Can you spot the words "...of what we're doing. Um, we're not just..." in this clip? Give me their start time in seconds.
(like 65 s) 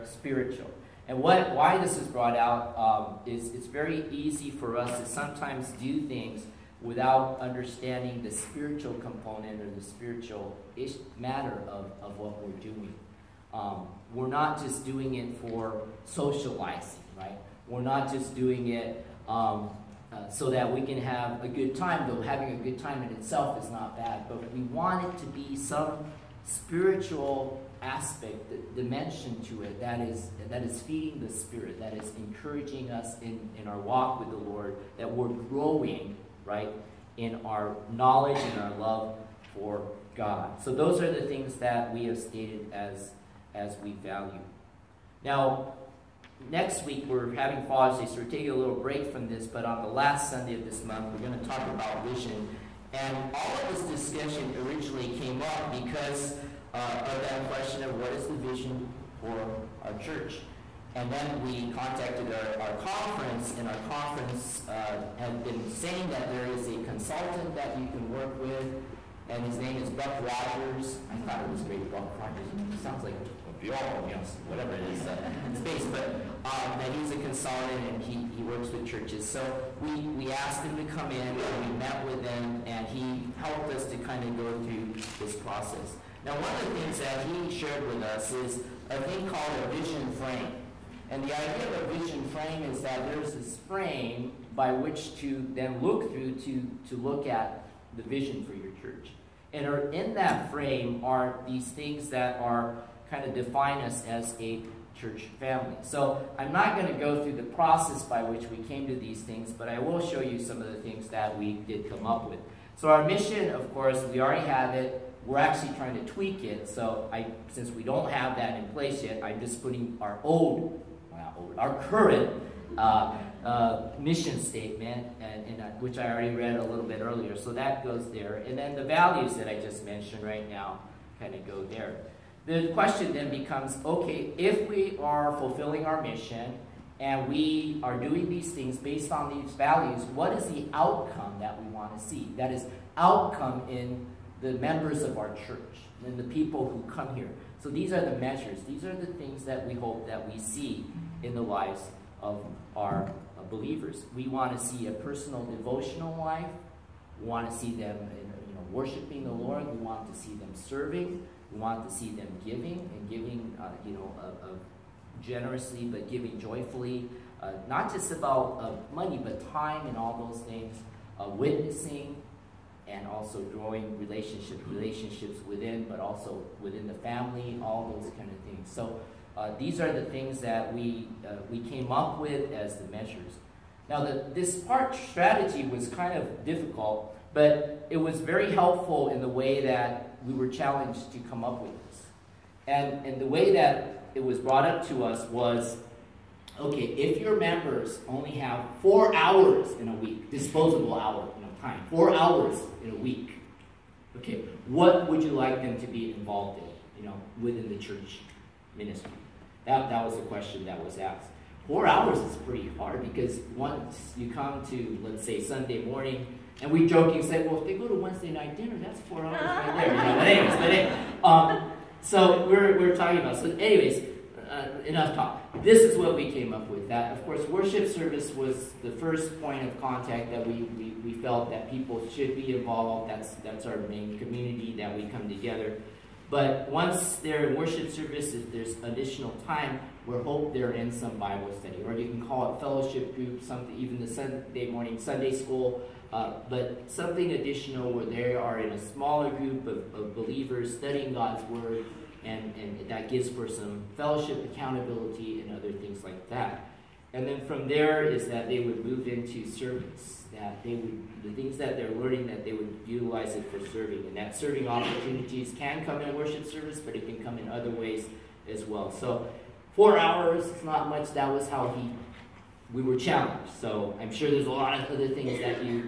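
12 s.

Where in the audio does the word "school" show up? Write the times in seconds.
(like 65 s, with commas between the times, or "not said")
245 s.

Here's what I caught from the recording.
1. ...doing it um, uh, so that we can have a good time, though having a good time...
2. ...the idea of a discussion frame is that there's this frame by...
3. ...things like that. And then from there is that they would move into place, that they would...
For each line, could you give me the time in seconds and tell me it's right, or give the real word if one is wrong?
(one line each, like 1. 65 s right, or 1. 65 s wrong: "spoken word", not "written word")
1. 18 s right
2. 91 s wrong: "vision", not "discussion"
3. 255 s wrong: "service", not "place".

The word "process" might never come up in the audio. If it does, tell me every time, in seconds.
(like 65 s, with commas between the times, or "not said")
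85 s, 107 s.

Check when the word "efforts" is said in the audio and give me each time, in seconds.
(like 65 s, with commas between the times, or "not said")
not said.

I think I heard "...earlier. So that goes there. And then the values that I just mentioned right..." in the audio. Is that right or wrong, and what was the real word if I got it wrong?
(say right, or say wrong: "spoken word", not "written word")
right.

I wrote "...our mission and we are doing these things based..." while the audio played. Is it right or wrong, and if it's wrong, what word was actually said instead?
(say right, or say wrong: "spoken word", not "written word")
right.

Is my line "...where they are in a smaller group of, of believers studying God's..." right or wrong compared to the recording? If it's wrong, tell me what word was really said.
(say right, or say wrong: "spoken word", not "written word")
right.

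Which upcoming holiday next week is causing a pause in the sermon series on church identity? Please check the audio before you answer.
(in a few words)
Father's Day.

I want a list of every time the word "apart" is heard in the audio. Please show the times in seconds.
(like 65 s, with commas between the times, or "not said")
not said.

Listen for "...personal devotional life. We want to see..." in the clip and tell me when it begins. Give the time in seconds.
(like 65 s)
154 s.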